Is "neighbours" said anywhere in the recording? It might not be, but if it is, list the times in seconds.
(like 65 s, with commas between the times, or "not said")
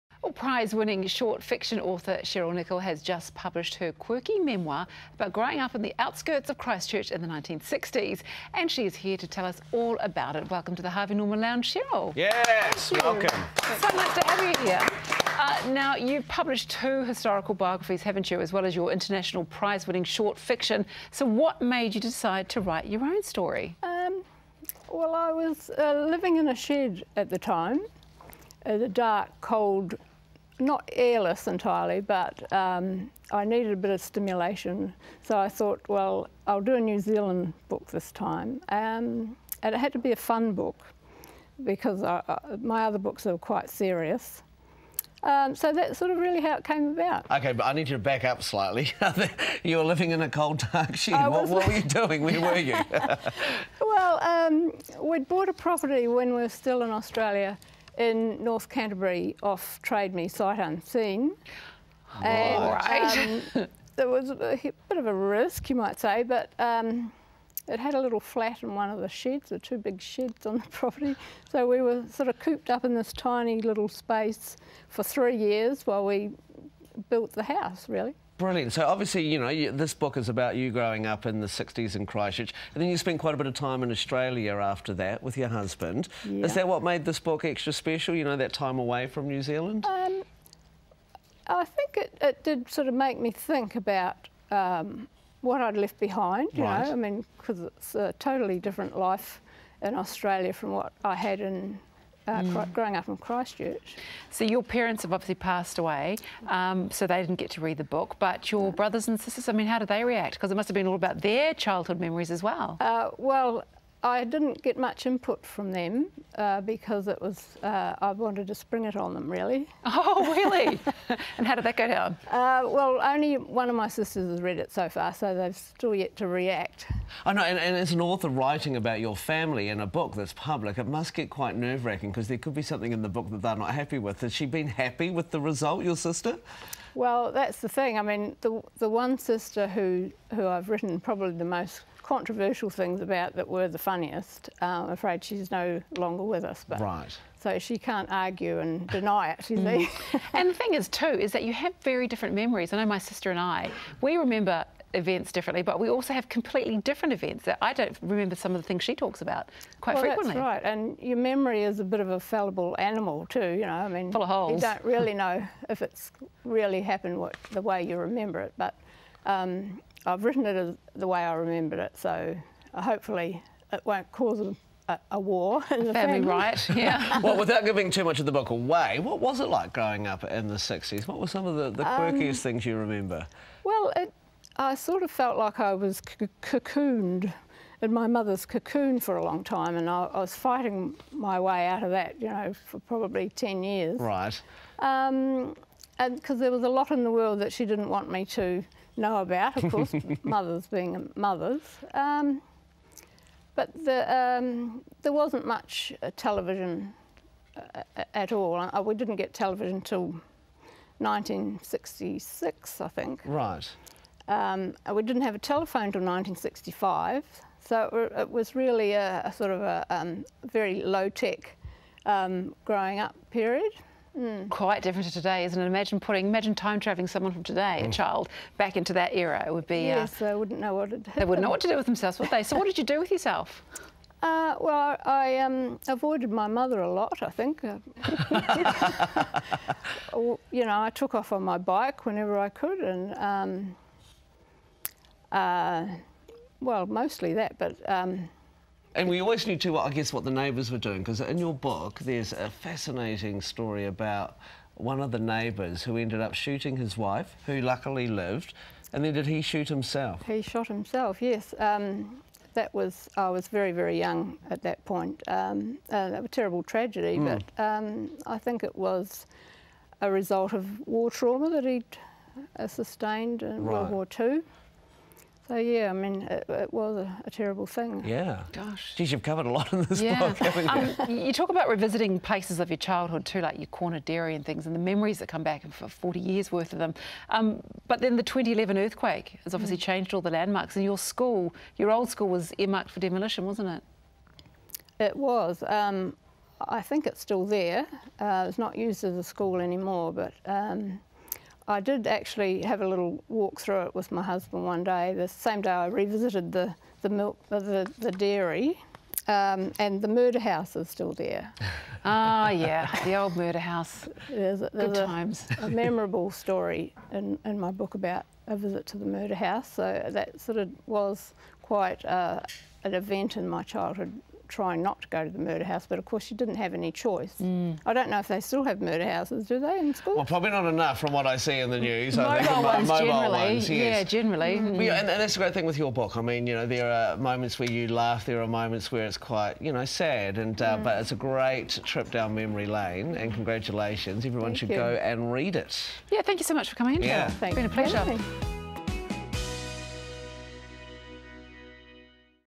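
250 s, 255 s.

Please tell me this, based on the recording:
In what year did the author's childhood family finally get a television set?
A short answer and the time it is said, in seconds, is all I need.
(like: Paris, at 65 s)
1966, at 210 s.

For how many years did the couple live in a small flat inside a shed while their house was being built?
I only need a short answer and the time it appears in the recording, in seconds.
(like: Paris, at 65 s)
3, at 75 s.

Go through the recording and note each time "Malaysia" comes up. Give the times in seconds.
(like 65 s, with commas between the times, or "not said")
not said.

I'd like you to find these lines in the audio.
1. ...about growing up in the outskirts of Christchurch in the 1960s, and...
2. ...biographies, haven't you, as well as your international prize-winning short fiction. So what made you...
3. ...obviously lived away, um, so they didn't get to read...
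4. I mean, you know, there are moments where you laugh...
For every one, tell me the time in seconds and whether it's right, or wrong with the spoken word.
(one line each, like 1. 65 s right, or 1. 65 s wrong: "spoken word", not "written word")
1. 5 s right
2. 17 s right
3. 105 s wrong: "passed", not "lived"
4. 336 s right.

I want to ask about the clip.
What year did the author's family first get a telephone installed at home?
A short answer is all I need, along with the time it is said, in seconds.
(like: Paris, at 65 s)
1965, at 216 s.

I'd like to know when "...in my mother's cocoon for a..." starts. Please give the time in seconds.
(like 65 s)
187 s.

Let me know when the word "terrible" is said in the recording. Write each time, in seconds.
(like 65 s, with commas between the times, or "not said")
266 s, 277 s.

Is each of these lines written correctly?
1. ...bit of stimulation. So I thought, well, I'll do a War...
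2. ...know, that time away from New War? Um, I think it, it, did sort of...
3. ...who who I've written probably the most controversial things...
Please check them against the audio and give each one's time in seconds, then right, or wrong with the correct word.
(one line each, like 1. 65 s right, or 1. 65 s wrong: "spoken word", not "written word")
1. 33 s wrong: "New", not "War"
2. 88 s wrong: "Zealand", not "War"
3. 139 s right.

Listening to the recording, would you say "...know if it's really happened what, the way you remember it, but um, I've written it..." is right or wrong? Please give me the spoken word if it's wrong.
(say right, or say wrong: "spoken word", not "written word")
right.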